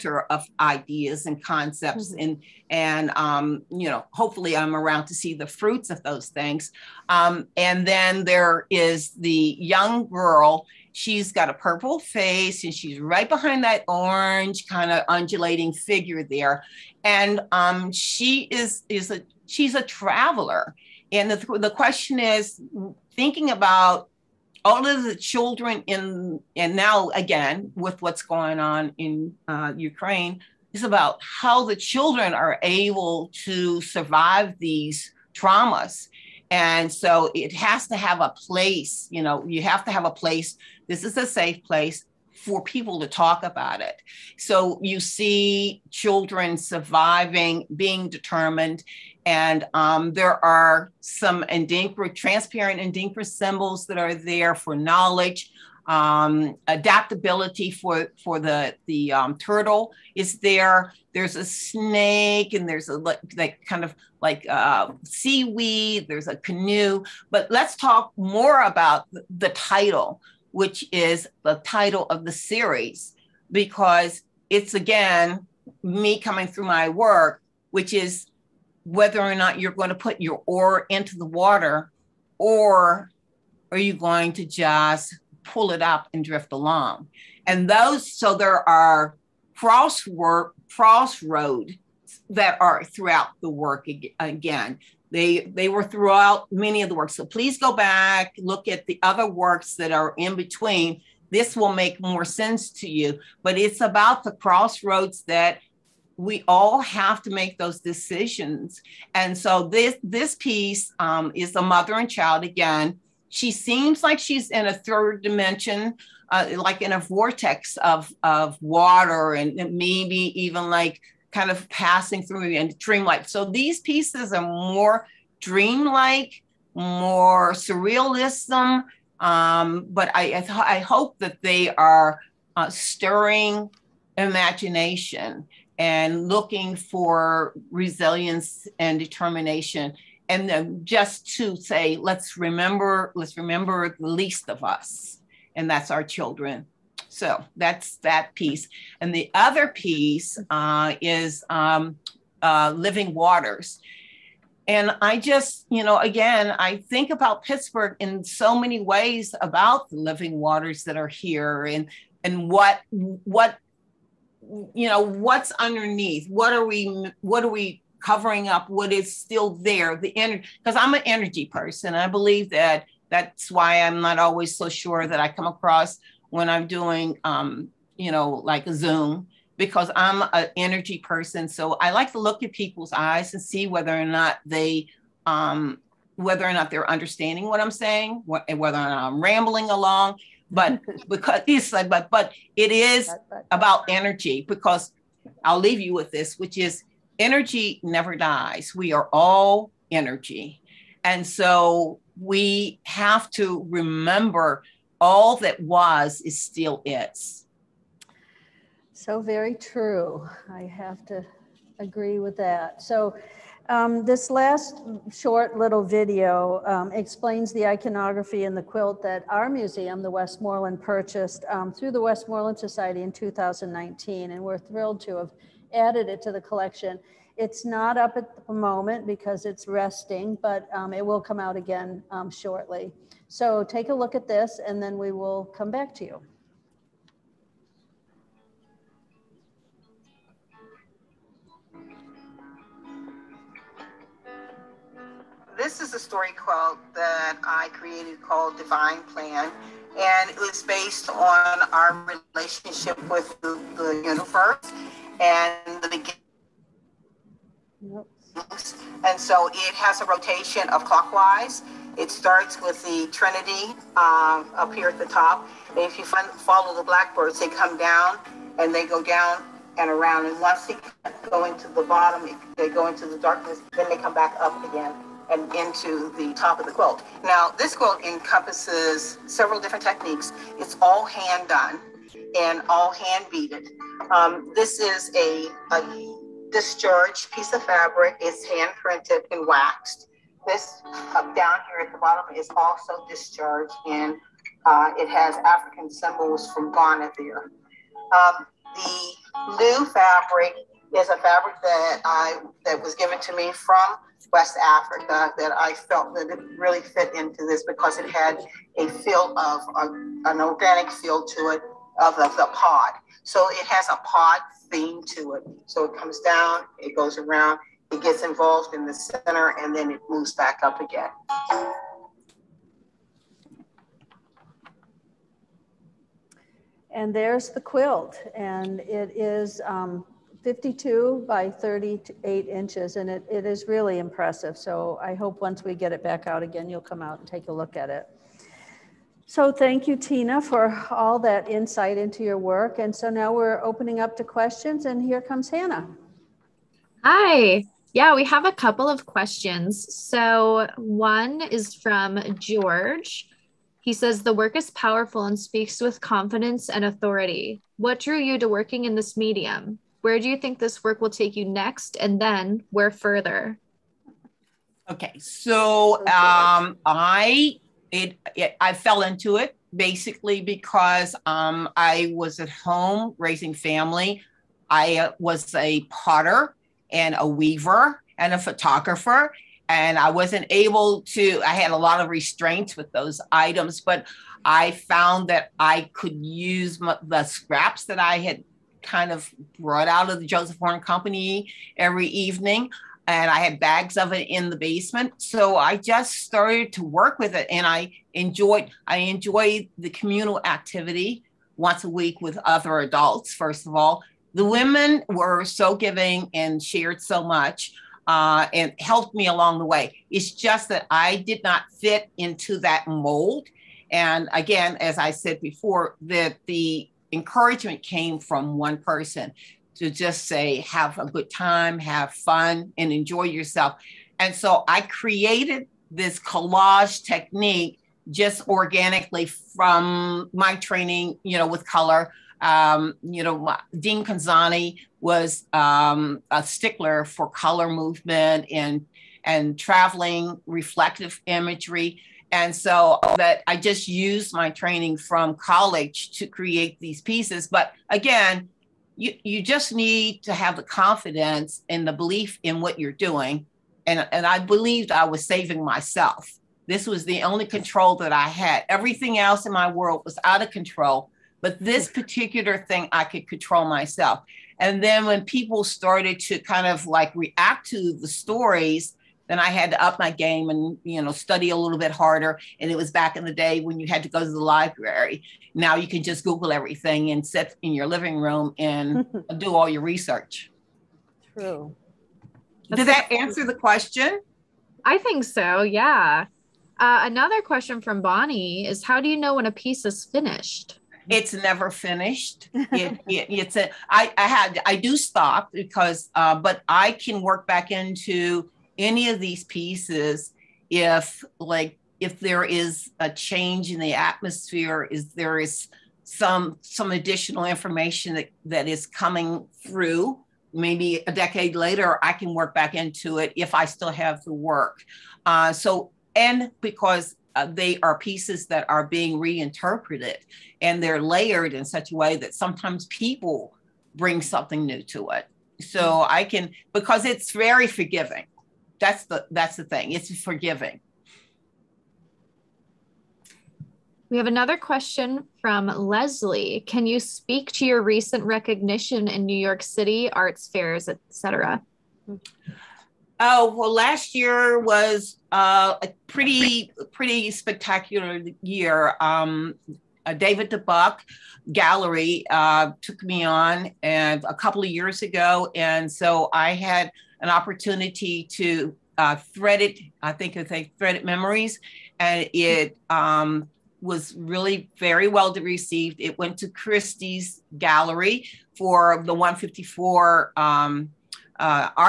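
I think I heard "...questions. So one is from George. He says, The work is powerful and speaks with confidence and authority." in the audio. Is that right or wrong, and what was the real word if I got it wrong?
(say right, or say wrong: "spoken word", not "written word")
right.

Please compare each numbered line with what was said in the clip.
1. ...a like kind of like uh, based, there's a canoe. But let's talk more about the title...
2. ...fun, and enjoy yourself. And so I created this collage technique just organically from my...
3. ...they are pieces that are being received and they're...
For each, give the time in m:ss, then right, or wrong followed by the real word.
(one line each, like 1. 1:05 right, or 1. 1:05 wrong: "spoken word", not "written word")
1. 1:02 wrong: "seaweed", not "based"
2. 7:02 right
3. 8:37 wrong: "reinterpreted", not "received".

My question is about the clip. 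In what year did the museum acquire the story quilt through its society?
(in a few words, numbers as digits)
2019.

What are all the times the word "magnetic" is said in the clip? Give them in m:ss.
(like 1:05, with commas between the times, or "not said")
not said.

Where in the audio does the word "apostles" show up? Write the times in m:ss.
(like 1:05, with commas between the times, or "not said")
not said.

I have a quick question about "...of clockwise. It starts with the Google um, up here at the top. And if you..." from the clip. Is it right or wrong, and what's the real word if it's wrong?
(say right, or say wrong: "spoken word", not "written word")
wrong: "Trinity", not "Google".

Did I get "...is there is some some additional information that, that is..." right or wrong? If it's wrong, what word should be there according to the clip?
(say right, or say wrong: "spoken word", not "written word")
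right.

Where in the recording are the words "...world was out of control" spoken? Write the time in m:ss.
7:39.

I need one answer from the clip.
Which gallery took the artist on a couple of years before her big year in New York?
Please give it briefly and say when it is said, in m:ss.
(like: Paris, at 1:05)
David De Buck Gallery, at 9:10.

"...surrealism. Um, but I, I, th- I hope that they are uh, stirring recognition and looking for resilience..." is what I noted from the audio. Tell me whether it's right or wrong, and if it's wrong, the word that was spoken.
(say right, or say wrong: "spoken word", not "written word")
wrong: "imagination", not "recognition".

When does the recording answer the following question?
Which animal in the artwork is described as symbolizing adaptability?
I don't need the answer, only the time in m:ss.
0:59.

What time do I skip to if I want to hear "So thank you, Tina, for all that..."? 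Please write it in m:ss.
5:39.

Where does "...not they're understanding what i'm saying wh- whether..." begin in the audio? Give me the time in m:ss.
3:06.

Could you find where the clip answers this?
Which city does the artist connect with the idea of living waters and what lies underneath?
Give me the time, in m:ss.
2:37.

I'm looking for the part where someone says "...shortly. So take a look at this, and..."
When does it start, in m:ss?
3:52.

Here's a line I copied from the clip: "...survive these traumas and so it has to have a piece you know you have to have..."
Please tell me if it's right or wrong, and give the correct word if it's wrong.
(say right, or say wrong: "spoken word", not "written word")
wrong: "place", not "piece".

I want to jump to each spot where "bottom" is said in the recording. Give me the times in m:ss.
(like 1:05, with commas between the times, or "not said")
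4:31, 4:51.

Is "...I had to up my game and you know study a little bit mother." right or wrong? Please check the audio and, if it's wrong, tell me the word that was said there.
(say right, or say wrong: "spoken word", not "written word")
wrong: "harder", not "mother".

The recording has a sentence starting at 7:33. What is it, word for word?
And, and I believed I was saving myself.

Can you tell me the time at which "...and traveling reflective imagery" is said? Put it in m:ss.
7:19.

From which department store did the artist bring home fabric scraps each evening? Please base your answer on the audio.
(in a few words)
Joseph Horne Company.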